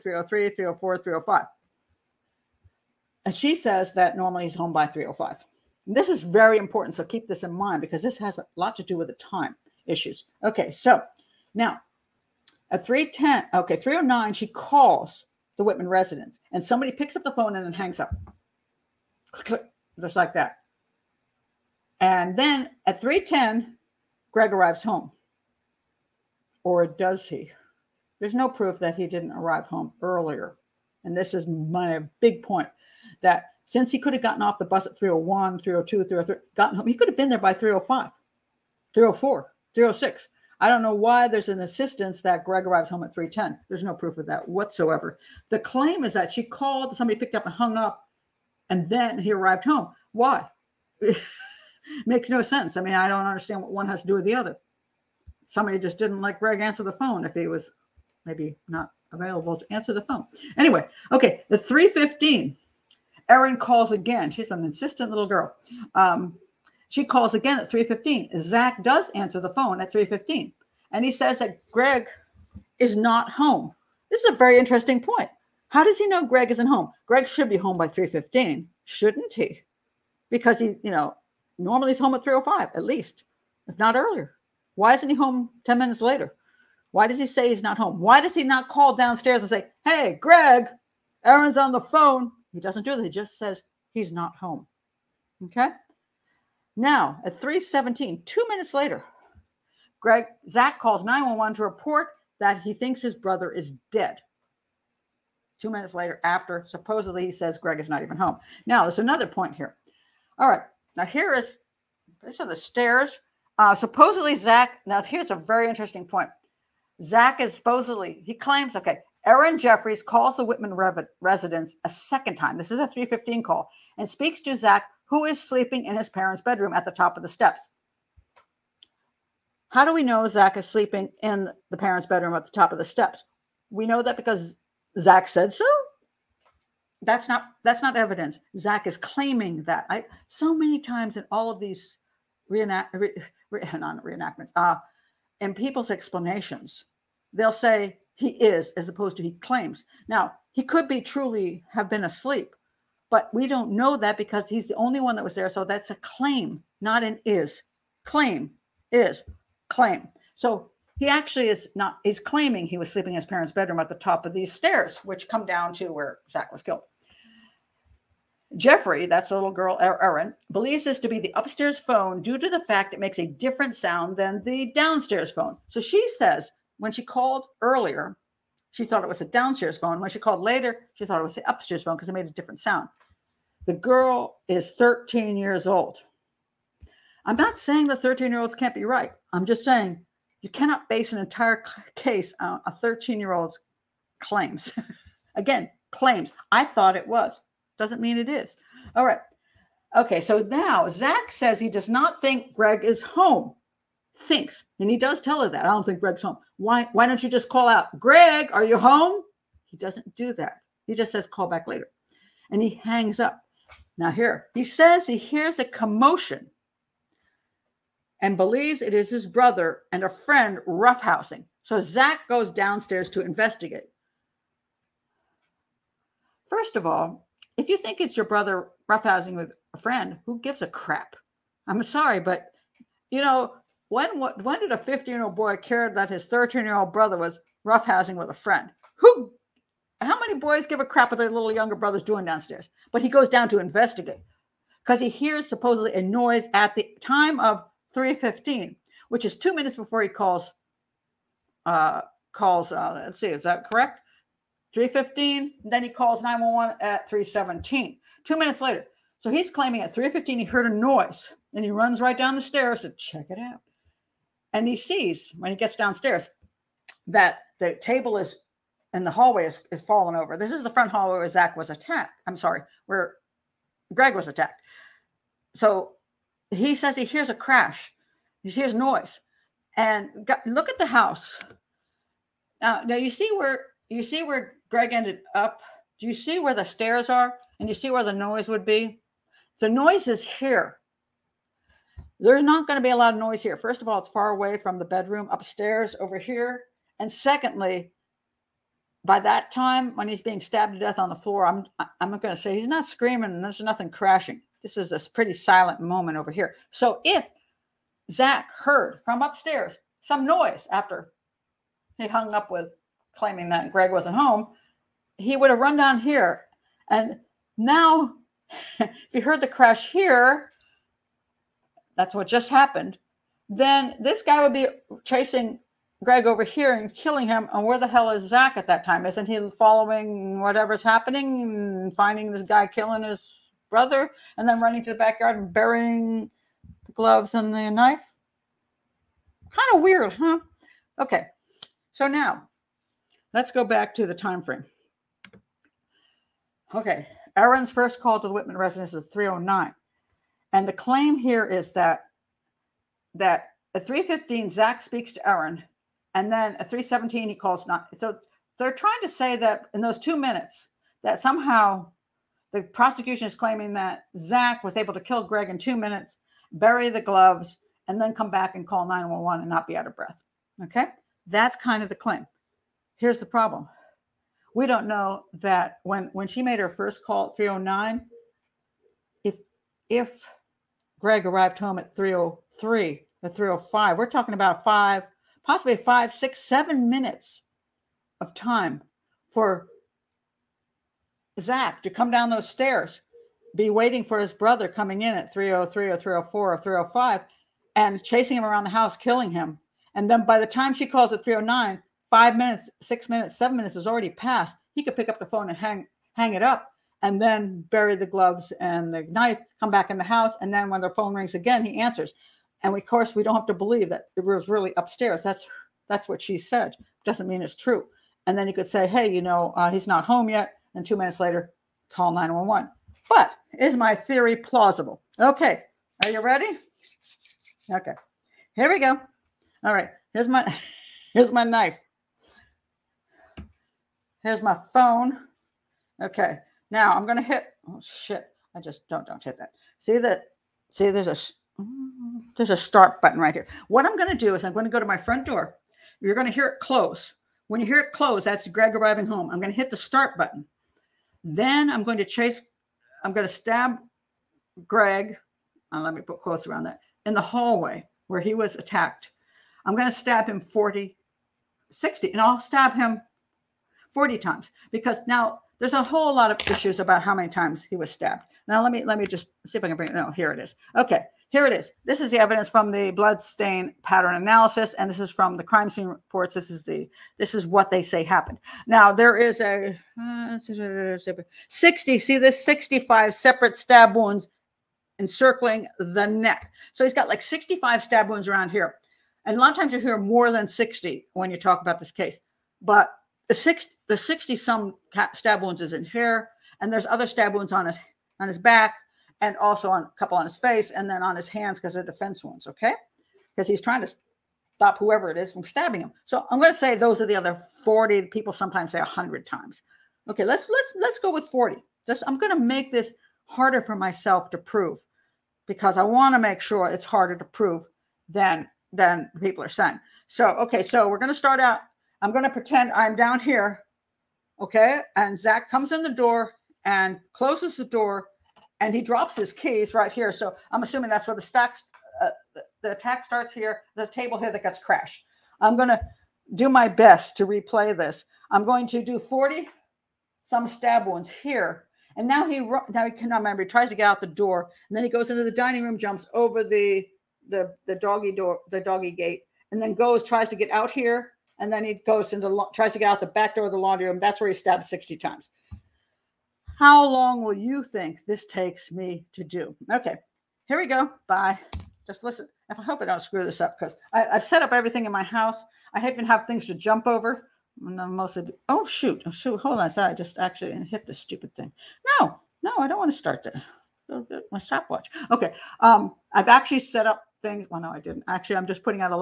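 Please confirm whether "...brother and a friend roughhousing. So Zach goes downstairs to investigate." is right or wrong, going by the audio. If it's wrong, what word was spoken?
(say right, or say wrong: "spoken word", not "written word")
right.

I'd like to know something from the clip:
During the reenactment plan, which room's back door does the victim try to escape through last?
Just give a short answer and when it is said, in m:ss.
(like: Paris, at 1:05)
laundry room, at 9:13.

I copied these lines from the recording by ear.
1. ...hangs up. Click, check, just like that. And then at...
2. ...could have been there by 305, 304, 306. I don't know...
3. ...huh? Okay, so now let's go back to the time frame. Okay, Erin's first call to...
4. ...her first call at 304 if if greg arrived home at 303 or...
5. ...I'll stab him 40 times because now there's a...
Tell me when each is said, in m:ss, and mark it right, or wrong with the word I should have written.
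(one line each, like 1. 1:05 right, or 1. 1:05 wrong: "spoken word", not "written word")
1. 0:17 wrong: "click", not "check"
2. 0:36 right
3. 5:40 right
4. 6:16 wrong: "309", not "304"
5. 7:42 right.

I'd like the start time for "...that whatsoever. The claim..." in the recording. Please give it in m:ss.
0:44.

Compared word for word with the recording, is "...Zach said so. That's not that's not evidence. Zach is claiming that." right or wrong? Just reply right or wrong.
right.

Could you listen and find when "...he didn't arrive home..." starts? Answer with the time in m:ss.
0:28.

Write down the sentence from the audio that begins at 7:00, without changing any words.
And two minutes later, call 911.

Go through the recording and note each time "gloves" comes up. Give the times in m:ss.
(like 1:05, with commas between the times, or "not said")
5:36, 6:07, 6:48.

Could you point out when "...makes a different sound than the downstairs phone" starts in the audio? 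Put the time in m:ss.
2:52.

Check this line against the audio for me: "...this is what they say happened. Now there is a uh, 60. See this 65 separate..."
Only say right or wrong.
right.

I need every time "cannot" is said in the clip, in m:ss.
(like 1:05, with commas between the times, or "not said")
3:10, 9:02.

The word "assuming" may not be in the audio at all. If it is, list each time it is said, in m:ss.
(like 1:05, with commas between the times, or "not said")
8:50.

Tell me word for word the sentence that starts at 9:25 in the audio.
I even have things to jump over.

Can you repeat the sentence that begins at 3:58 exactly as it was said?
Who how many boys give a crap what their little younger brother's doing downstairs?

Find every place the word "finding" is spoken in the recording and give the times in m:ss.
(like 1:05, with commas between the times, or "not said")
5:31.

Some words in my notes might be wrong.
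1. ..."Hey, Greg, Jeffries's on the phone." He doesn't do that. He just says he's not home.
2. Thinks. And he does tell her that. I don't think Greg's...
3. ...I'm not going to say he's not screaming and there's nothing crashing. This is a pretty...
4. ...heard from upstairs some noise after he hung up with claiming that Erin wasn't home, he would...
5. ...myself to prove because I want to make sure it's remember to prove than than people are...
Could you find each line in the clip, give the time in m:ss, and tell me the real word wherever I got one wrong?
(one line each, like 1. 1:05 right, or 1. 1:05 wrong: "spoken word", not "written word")
1. 1:29 wrong: "Erin", not "Jeffries"
2. 3:24 right
3. 5:01 right
4. 5:08 wrong: "Greg", not "Erin"
5. 8:33 wrong: "harder", not "remember".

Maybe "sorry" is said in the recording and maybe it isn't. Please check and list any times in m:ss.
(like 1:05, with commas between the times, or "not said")
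3:51, 4:32.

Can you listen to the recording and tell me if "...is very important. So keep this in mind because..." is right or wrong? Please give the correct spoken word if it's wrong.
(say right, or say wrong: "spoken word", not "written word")
right.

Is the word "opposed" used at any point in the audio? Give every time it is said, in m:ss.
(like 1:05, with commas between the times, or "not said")
2:28.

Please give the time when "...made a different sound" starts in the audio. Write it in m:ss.
3:02.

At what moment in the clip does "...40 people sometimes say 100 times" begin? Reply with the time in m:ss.
8:27.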